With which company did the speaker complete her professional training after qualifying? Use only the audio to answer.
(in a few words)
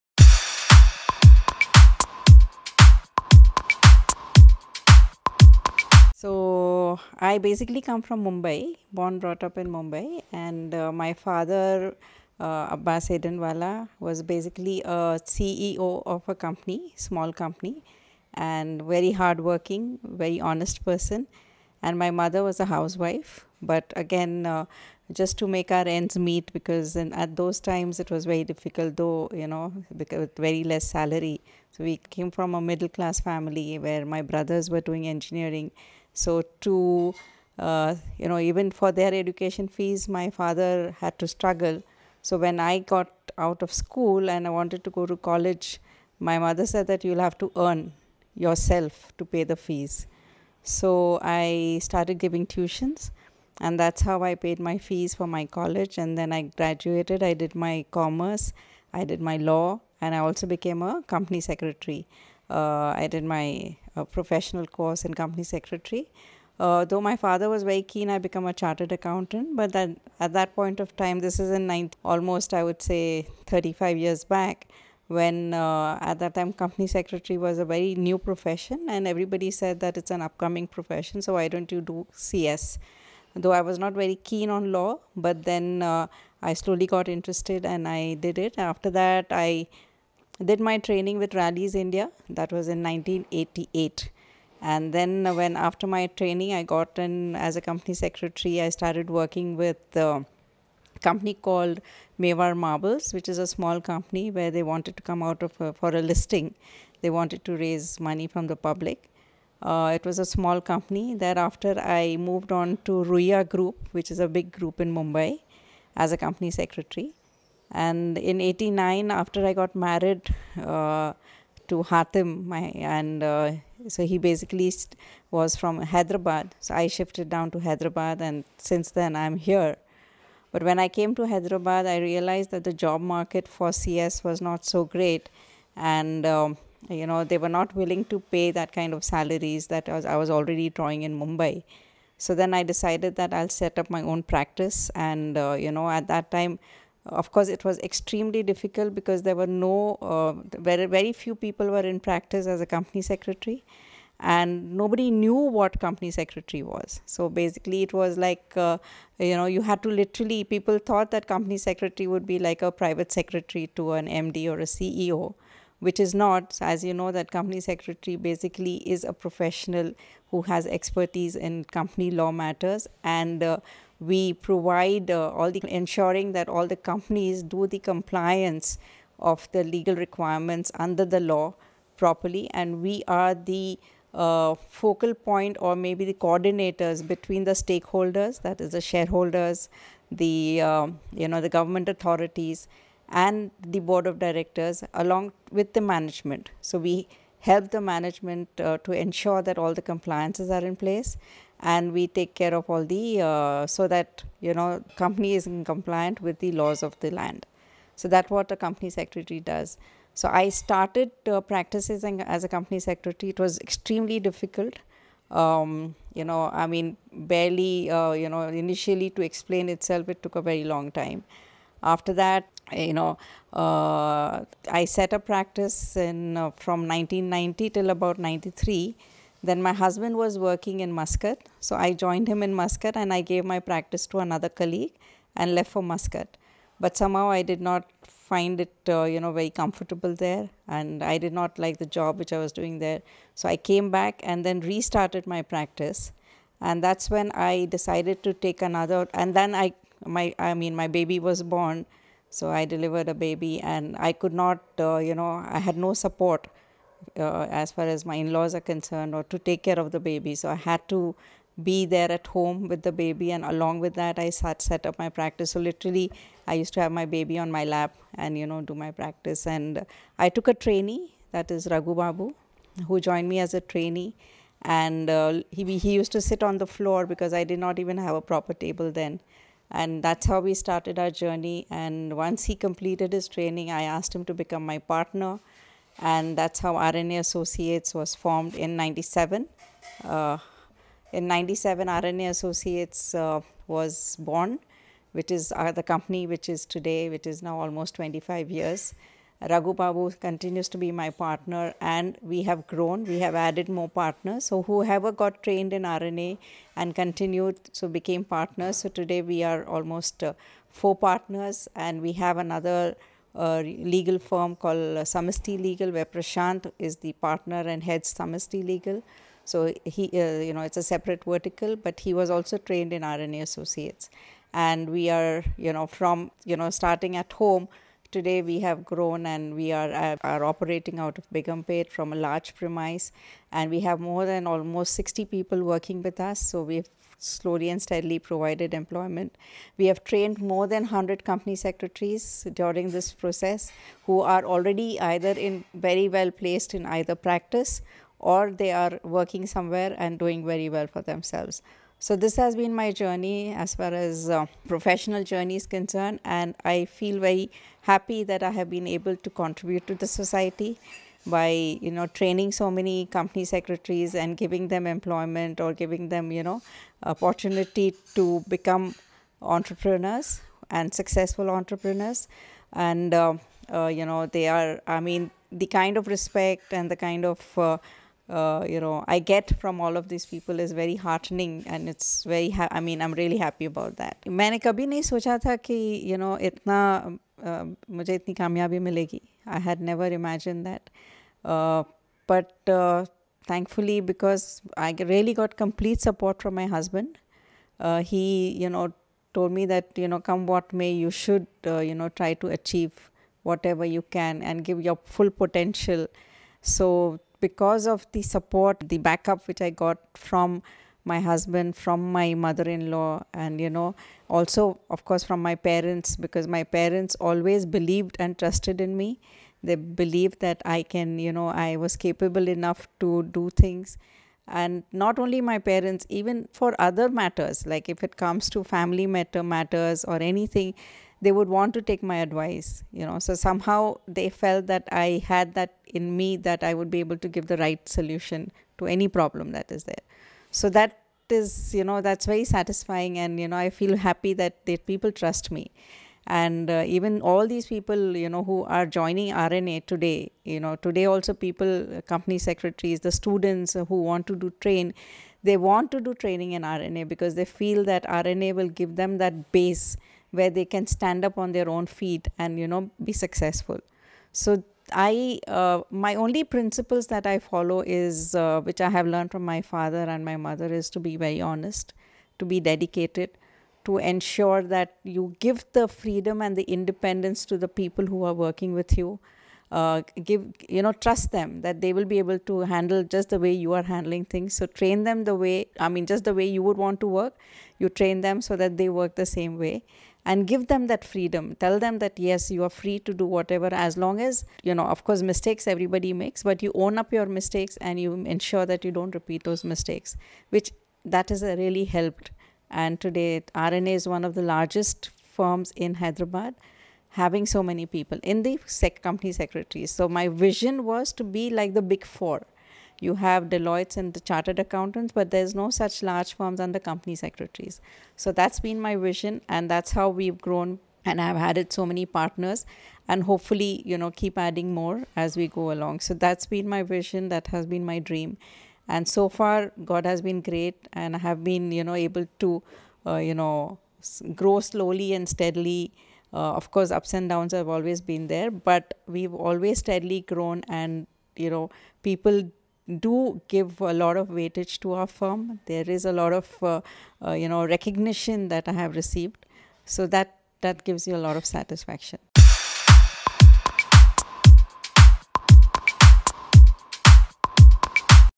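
Rallis India.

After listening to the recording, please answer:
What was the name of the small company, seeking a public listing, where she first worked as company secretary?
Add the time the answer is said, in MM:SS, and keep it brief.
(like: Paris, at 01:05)
Mewar Marbles, at 01:42.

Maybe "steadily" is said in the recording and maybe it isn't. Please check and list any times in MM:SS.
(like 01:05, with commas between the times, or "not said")
05:37, 08:55, 08:59.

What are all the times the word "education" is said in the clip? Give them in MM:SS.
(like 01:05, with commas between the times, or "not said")
00:39.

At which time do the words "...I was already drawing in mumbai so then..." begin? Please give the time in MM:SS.
02:20.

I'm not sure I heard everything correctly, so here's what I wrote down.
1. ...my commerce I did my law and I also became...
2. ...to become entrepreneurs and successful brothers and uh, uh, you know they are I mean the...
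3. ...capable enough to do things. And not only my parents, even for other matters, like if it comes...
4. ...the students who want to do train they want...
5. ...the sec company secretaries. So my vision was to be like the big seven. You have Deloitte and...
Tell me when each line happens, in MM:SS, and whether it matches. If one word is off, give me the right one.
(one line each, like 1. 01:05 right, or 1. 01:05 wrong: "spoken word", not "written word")
1. 00:57 right
2. 06:08 wrong: "entrepreneurs", not "brothers"
3. 07:01 right
4. 07:33 right
5. 08:28 wrong: "four", not "seven".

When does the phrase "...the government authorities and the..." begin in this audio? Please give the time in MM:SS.
03:11.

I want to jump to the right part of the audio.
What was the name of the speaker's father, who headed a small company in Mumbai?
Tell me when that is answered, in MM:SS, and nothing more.
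00:12.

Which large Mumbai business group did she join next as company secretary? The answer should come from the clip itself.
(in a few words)
Ruia Group.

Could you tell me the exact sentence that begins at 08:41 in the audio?
And I've added so many partners, and hopefully, you know, keep adding more as we go along.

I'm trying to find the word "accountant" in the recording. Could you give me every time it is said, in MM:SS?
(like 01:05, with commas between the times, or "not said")
01:08, 08:34.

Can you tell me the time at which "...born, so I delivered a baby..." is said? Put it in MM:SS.
04:11.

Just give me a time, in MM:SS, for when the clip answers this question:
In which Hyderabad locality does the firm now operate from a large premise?
05:31.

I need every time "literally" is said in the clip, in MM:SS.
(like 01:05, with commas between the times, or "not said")
02:39, 04:25.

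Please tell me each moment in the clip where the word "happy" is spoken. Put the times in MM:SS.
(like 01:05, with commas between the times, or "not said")
05:57, 06:23, 07:23.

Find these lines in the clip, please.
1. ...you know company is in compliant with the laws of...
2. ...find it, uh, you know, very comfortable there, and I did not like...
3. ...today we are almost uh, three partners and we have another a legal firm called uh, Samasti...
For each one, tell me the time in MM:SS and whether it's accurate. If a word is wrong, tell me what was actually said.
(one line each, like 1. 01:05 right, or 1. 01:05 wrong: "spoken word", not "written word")
1. 03:24 right
2. 03:58 right
3. 05:08 wrong: "four", not "three".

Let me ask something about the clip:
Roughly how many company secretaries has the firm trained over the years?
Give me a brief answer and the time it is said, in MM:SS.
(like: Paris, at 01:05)
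100, at 05:40.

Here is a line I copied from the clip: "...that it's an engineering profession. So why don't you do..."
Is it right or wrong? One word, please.
wrong.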